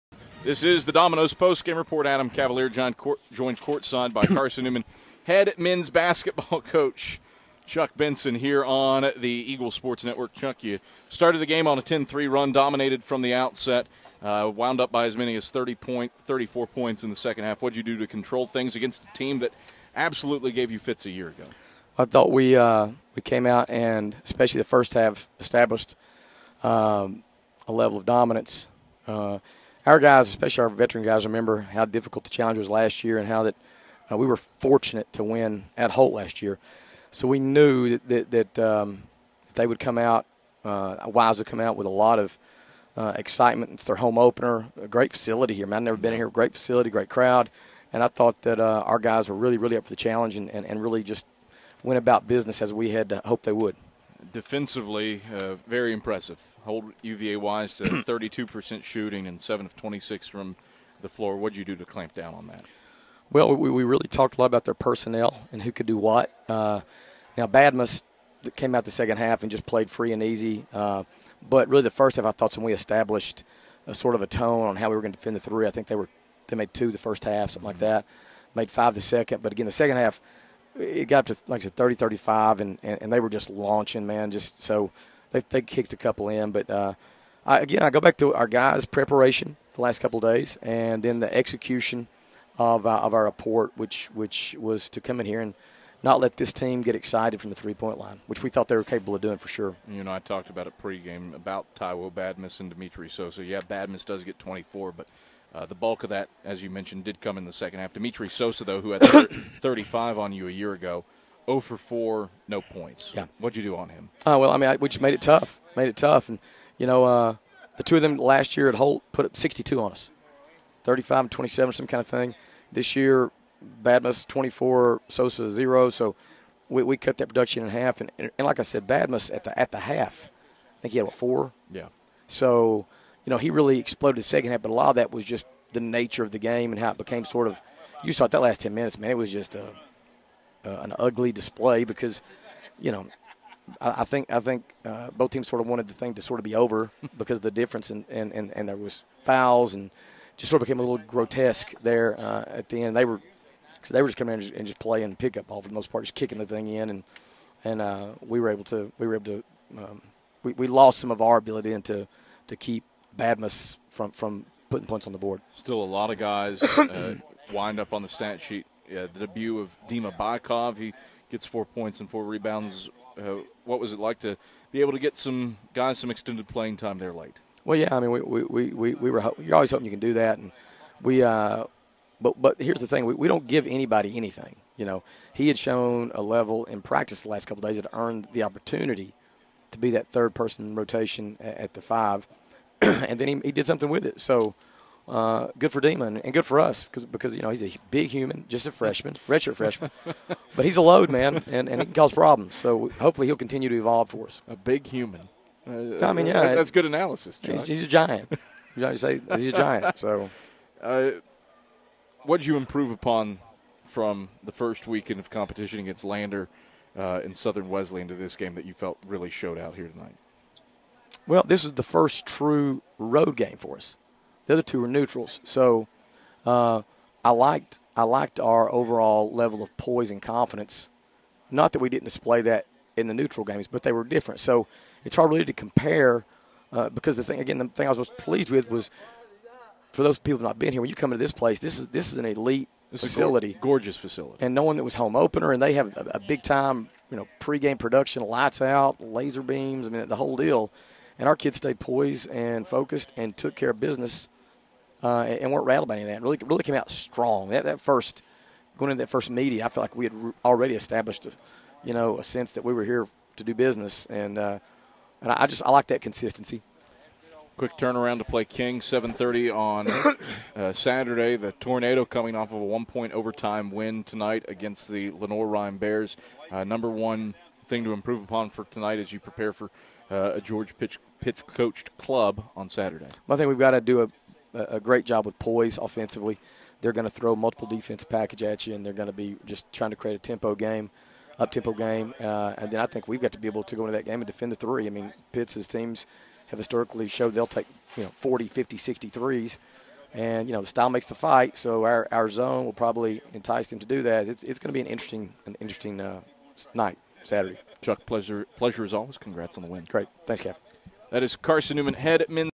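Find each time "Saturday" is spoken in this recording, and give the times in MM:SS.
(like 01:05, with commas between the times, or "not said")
04:30, 04:42, 05:07.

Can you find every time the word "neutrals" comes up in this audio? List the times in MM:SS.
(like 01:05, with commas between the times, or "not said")
03:44, 03:53.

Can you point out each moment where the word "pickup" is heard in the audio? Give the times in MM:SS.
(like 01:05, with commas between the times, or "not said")
02:35.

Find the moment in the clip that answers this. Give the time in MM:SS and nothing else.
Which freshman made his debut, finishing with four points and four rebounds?
02:49.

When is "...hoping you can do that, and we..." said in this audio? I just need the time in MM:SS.
02:59.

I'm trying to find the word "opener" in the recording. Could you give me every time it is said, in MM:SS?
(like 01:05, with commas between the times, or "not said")
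00:44, 04:05.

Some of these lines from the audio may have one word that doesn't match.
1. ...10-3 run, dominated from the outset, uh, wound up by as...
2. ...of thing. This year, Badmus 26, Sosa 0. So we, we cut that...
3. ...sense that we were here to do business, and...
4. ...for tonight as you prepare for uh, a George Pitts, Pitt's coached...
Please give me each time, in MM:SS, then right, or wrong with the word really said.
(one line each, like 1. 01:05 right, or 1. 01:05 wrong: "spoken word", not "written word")
1. 00:11 right
2. 02:01 wrong: "24", not "26"
3. 04:22 right
4. 04:38 right.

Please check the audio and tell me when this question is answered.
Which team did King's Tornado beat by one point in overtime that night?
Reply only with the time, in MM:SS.
04:35.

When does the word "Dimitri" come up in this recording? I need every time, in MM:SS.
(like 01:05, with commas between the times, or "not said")
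01:42, 01:47.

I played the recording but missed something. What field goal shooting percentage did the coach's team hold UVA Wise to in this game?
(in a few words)
32%.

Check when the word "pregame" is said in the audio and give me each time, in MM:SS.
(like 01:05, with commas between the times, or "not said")
01:40, 04:07.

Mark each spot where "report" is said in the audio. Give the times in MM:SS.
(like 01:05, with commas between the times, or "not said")
00:01, 01:33.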